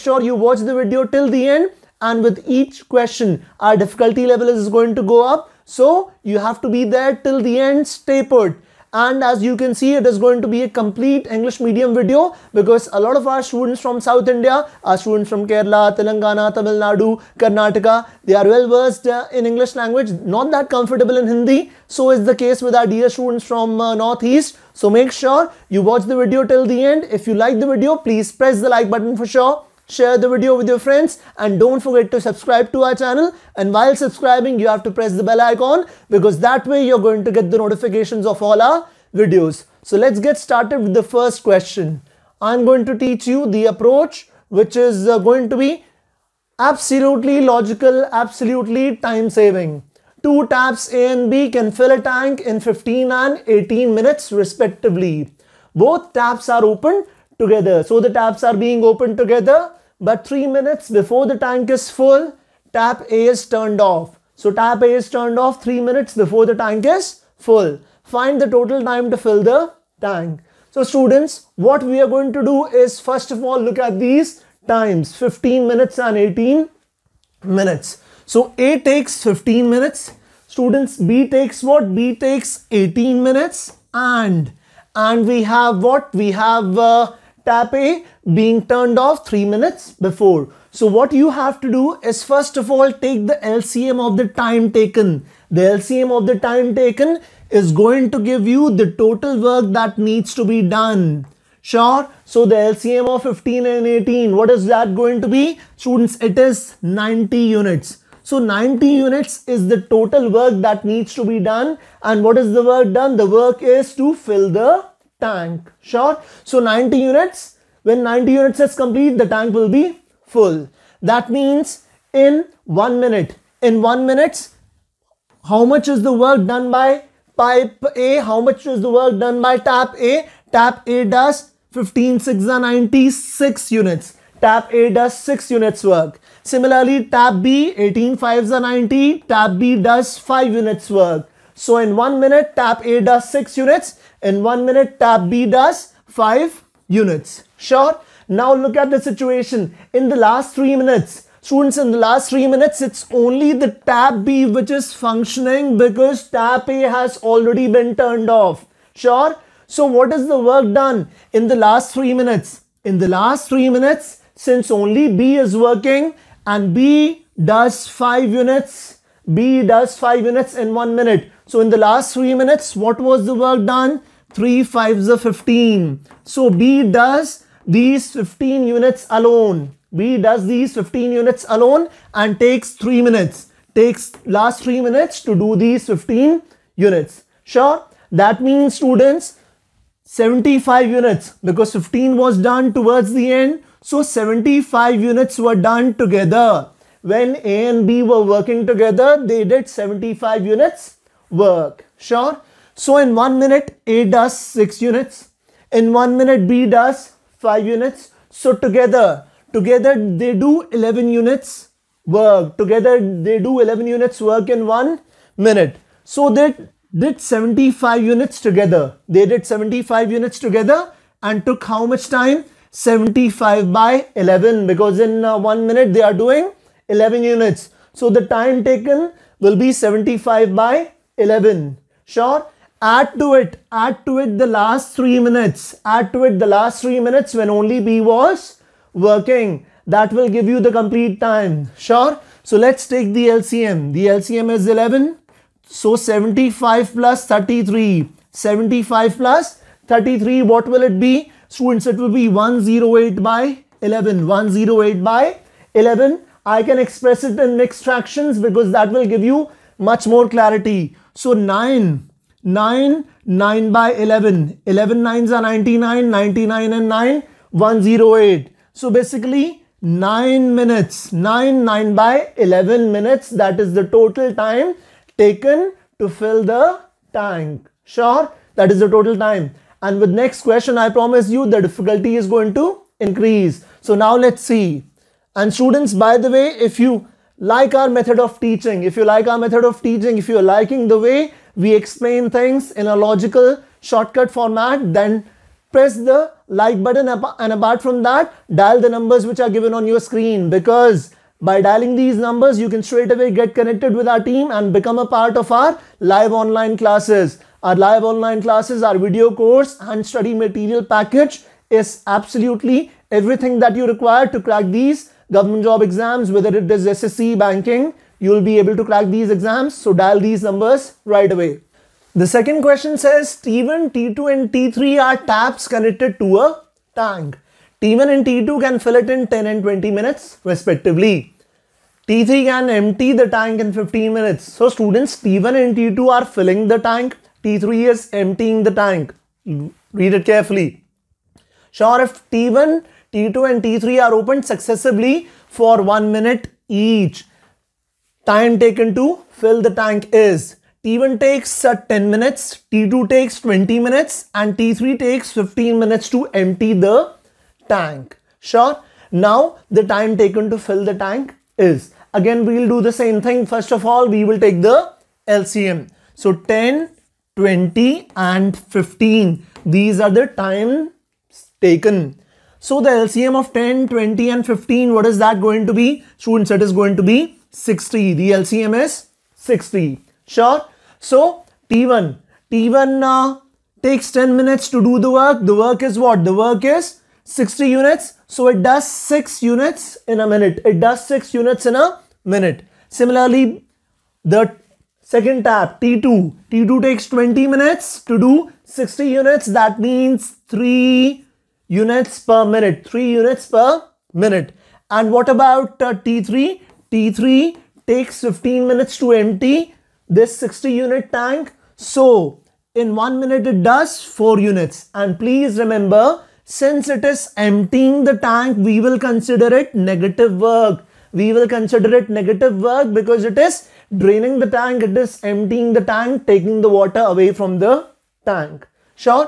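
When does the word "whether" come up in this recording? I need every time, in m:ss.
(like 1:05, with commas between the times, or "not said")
5:16.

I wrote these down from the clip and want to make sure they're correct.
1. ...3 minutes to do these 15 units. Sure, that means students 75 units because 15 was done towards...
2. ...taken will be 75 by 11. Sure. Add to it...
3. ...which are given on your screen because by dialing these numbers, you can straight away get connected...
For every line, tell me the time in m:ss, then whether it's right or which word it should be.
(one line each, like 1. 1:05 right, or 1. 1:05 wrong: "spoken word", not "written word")
1. 3:04 right
2. 3:48 right
3. 4:59 right.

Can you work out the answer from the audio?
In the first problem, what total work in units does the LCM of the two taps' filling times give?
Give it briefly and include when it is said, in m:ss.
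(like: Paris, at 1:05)
90 units, at 1:46.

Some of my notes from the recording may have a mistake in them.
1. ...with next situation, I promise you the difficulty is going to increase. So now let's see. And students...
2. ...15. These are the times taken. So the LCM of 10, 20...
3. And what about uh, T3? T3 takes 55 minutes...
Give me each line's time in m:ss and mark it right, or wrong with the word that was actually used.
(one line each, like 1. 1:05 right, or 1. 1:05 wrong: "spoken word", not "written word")
1. 4:39 wrong: "question", not "situation"
2. 6:08 right
3. 6:44 wrong: "15", not "55".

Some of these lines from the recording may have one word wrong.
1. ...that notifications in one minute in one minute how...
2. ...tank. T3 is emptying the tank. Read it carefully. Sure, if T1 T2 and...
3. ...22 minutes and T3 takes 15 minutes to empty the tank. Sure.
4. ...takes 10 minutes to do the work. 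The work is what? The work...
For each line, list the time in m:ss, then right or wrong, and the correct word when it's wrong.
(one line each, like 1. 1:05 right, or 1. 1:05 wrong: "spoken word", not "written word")
1. 2:01 wrong: "means", not "notifications"
2. 5:36 right
3. 5:53 wrong: "20", not "22"
4. 6:23 right.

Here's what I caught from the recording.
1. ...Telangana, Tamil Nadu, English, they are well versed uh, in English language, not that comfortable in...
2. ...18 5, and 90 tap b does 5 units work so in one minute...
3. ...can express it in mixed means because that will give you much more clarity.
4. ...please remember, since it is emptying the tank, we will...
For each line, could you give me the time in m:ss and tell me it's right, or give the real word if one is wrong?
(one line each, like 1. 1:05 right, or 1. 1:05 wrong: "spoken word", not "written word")
1. 0:15 wrong: "Karnataka", not "English"
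2. 2:17 right
3. 4:16 wrong: "fractions", not "means"
4. 6:55 right.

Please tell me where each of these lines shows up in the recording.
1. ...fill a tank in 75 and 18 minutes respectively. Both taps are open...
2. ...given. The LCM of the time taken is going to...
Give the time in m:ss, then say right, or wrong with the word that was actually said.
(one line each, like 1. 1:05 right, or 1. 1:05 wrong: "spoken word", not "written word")
1. 0:51 wrong: "15", not "75"
2. 1:34 wrong: "taken", not "given".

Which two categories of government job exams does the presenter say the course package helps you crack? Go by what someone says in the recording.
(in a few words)
SSC, banking.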